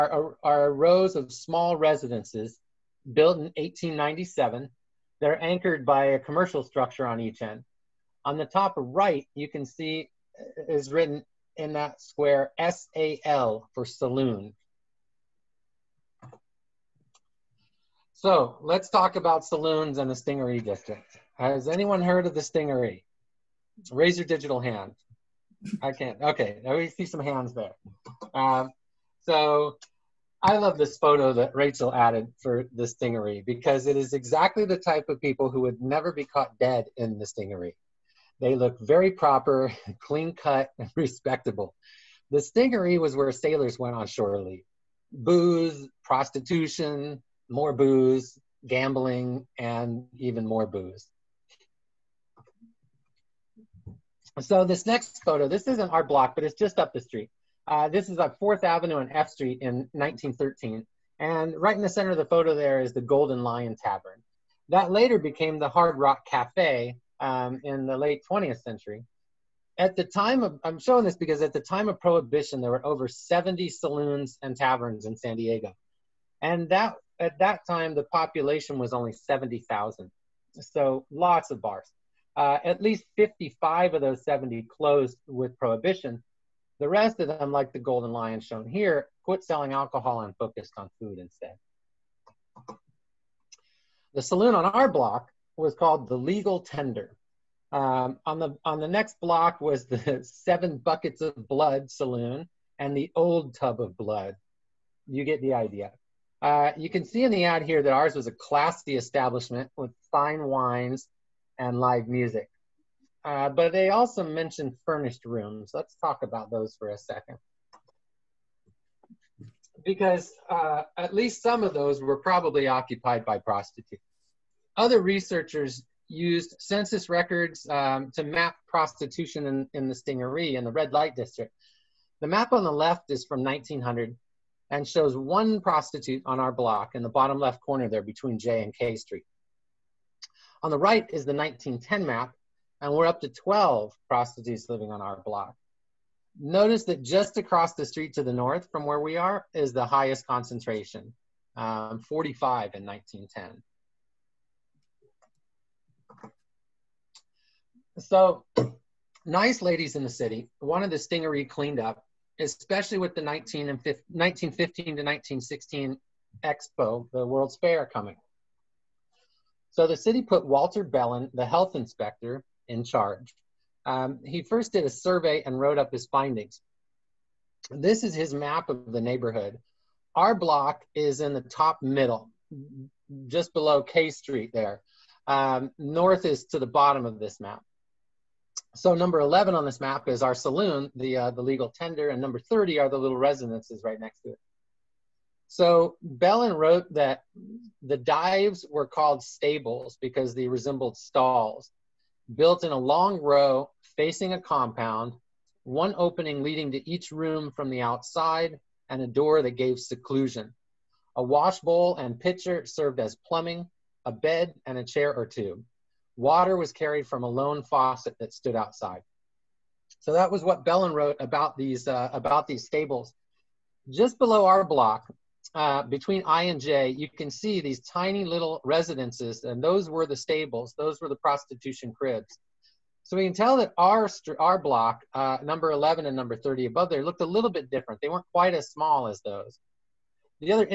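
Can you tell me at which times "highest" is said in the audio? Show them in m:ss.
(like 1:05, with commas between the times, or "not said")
2:29.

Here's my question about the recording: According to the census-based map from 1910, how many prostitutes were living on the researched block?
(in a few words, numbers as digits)
12.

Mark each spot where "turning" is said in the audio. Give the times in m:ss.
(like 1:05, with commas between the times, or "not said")
not said.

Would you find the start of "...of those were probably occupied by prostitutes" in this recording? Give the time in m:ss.
2:01.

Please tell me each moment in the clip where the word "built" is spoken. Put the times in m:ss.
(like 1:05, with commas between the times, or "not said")
0:03, 3:22.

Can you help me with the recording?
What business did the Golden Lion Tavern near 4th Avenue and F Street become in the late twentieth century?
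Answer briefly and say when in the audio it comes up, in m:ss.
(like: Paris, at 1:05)
Hard Rock Cafe, at 1:05.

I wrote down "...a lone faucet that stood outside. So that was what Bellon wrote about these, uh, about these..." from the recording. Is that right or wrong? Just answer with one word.
right.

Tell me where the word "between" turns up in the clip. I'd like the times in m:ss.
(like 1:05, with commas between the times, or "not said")
2:18, 3:45.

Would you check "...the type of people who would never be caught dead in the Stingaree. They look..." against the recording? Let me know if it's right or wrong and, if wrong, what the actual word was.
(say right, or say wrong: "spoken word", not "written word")
right.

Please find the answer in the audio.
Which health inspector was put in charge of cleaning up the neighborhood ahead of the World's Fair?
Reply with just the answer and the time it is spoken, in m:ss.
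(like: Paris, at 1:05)
Walter Bellon, at 2:50.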